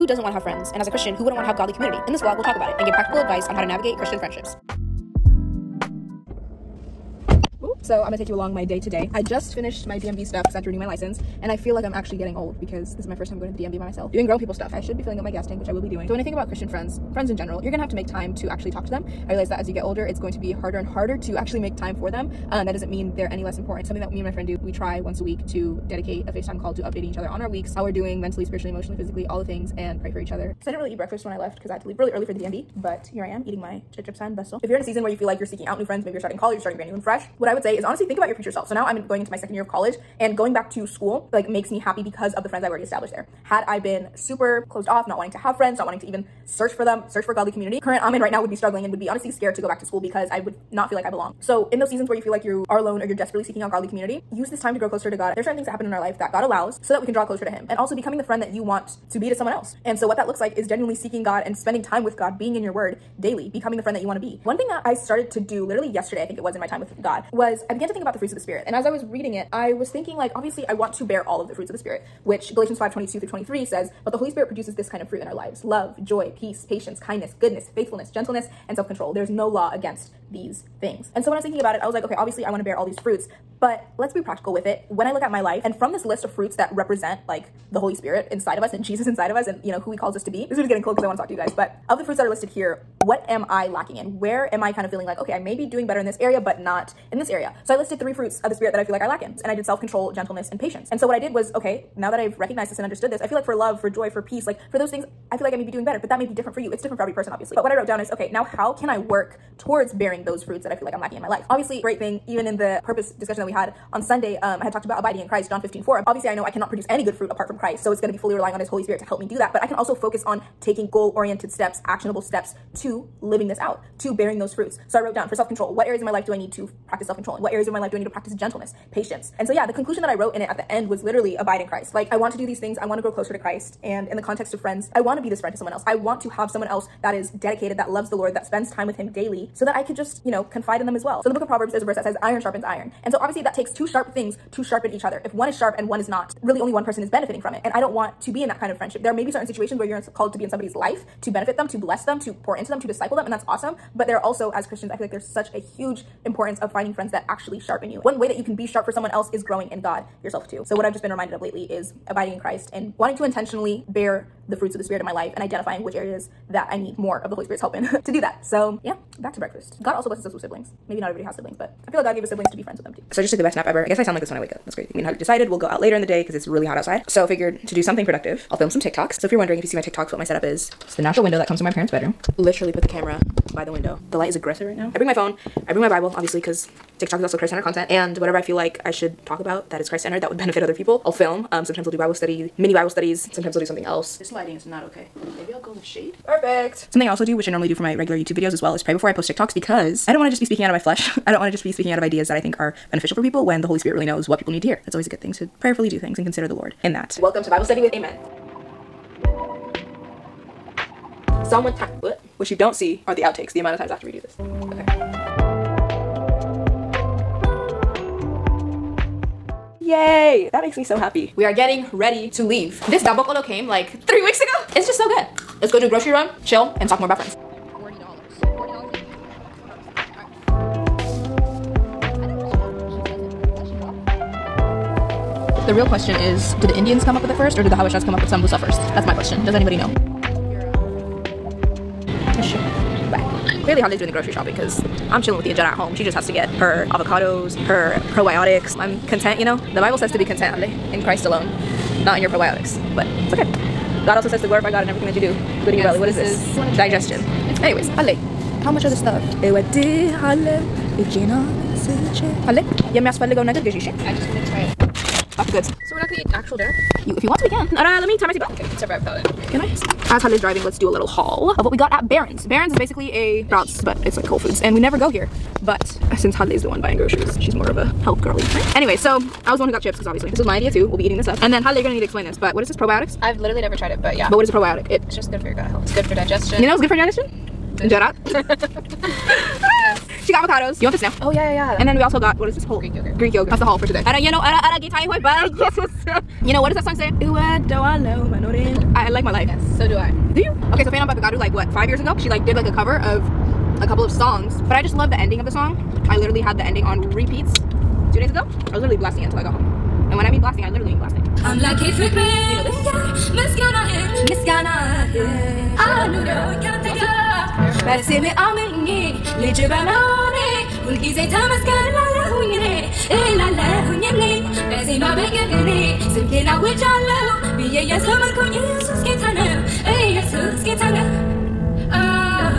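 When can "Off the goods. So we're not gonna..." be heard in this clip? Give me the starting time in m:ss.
4:25.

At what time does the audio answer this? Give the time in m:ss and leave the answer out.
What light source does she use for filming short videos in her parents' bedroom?
3:01.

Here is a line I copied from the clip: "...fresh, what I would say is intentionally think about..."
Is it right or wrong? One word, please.
wrong.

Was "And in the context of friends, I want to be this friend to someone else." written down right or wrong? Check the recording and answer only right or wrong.
right.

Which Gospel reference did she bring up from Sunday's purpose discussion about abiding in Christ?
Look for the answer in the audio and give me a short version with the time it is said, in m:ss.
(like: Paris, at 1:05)
John 15:4, at 1:55.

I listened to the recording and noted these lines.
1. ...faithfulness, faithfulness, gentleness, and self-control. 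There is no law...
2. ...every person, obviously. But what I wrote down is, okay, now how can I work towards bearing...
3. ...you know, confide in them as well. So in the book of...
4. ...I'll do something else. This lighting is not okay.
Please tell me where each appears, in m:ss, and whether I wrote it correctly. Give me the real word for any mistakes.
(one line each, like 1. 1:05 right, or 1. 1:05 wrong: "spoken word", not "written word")
1. 1:17 wrong: "goodness", not "faithfulness"
2. 1:47 right
3. 2:20 right
4. 3:13 right.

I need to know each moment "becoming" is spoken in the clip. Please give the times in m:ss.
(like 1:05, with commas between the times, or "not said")
0:57, 1:03.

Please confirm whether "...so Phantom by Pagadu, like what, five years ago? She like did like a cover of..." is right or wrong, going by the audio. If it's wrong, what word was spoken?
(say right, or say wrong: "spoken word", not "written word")
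right.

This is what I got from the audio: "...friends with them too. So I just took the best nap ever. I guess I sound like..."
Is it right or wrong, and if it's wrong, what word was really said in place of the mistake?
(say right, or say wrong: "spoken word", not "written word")
right.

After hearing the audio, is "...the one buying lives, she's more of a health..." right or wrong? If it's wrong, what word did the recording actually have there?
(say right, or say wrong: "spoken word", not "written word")
wrong: "groceries", not "lives".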